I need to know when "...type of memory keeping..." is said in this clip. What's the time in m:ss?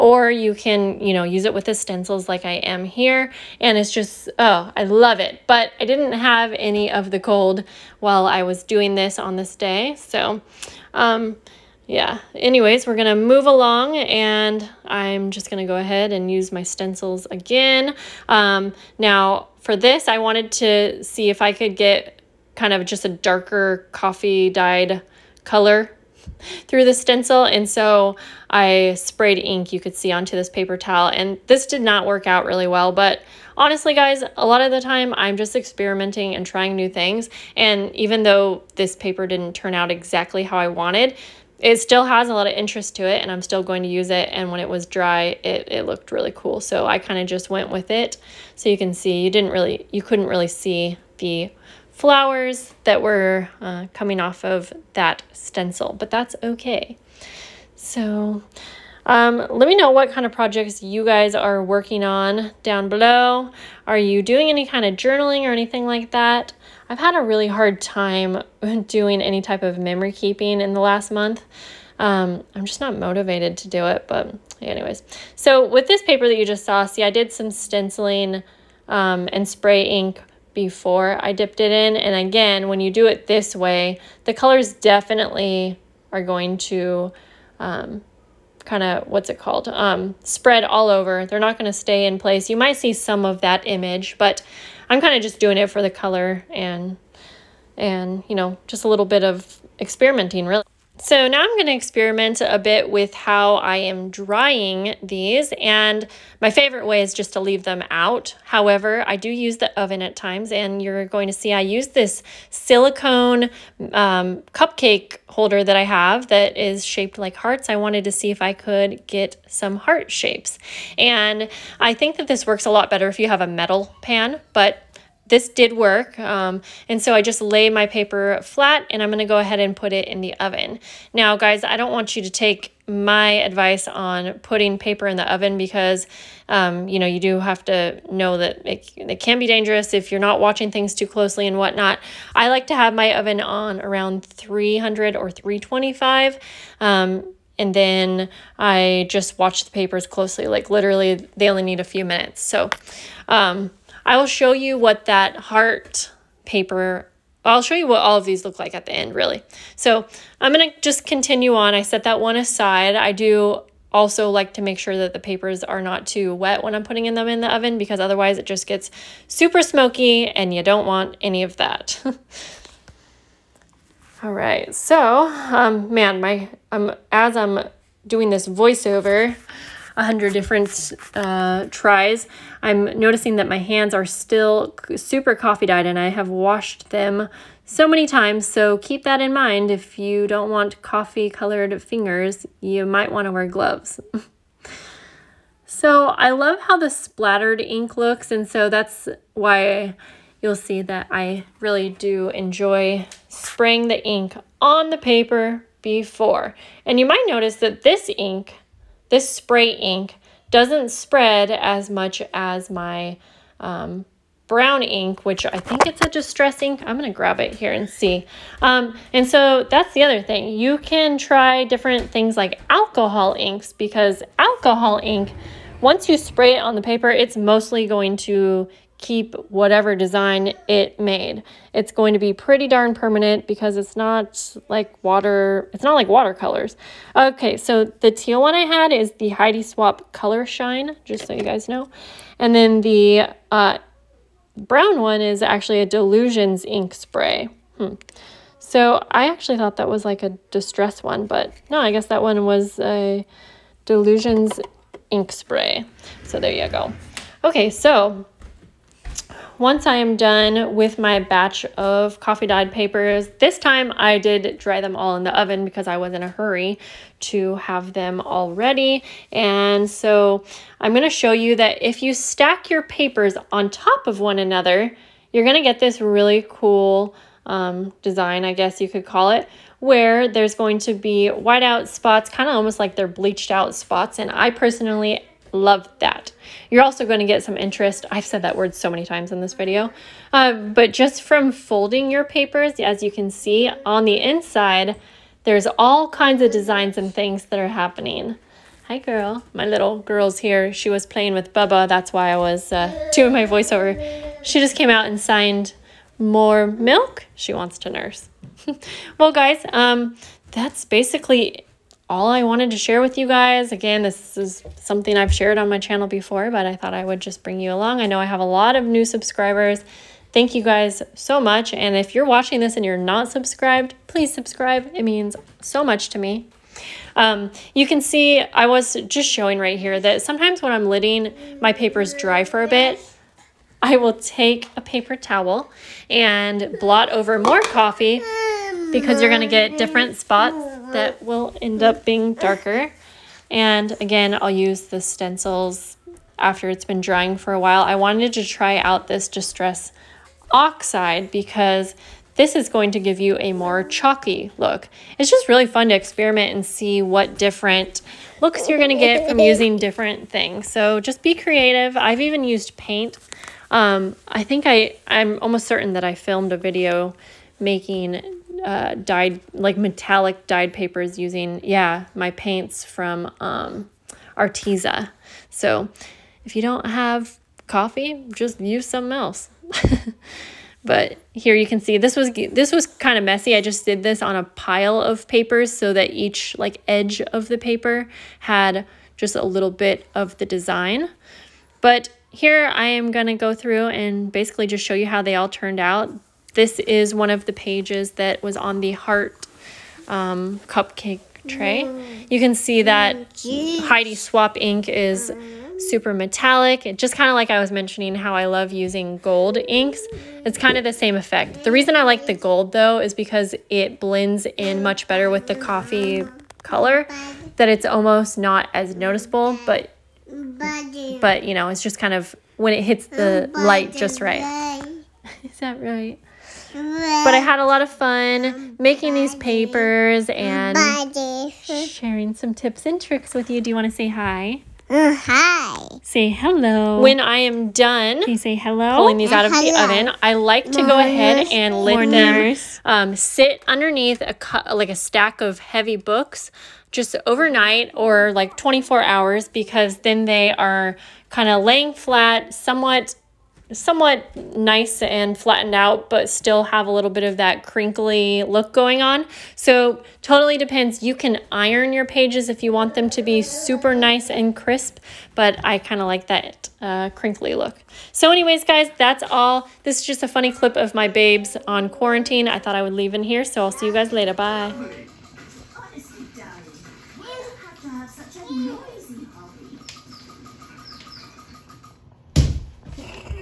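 1:09.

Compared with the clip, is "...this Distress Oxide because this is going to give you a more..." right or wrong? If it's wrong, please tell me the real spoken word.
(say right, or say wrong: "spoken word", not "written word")
right.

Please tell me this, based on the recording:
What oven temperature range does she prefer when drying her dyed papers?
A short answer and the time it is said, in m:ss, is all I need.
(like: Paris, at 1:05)
300 or 325, at 2:24.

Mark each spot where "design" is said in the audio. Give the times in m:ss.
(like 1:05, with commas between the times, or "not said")
3:49, 4:38, 4:56, 6:30.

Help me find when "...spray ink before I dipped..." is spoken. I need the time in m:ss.
1:19.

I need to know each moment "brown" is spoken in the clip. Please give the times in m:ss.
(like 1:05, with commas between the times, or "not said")
3:34, 4:04.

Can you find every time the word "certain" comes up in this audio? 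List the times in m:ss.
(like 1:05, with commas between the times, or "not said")
6:05.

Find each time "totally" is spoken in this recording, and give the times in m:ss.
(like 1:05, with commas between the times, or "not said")
7:40.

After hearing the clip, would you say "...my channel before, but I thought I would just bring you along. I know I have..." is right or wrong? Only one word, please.
right.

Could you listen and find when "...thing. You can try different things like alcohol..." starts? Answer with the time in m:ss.
3:40.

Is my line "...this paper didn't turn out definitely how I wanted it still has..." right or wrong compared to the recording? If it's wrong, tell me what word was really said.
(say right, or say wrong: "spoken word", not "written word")
wrong: "exactly", not "definitely".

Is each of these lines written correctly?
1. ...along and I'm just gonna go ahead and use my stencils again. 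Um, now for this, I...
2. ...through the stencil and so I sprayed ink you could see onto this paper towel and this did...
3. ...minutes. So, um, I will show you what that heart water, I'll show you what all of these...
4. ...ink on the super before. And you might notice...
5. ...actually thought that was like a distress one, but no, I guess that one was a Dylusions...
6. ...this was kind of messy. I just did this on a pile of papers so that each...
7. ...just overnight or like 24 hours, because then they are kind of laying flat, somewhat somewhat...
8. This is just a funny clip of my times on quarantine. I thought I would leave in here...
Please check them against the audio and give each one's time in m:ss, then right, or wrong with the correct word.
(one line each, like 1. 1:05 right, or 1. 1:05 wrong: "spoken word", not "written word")
1. 0:13 right
2. 0:26 right
3. 2:32 wrong: "paper", not "water"
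4. 3:24 wrong: "paper", not "super"
5. 4:09 right
6. 6:22 right
7. 7:26 right
8. 7:49 wrong: "babes", not "times".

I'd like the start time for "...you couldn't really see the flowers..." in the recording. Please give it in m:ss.
0:49.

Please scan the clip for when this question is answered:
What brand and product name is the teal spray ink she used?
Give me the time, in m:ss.
3:59.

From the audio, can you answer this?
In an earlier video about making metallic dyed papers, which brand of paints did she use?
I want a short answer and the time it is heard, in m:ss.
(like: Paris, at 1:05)
Arteza, at 6:14.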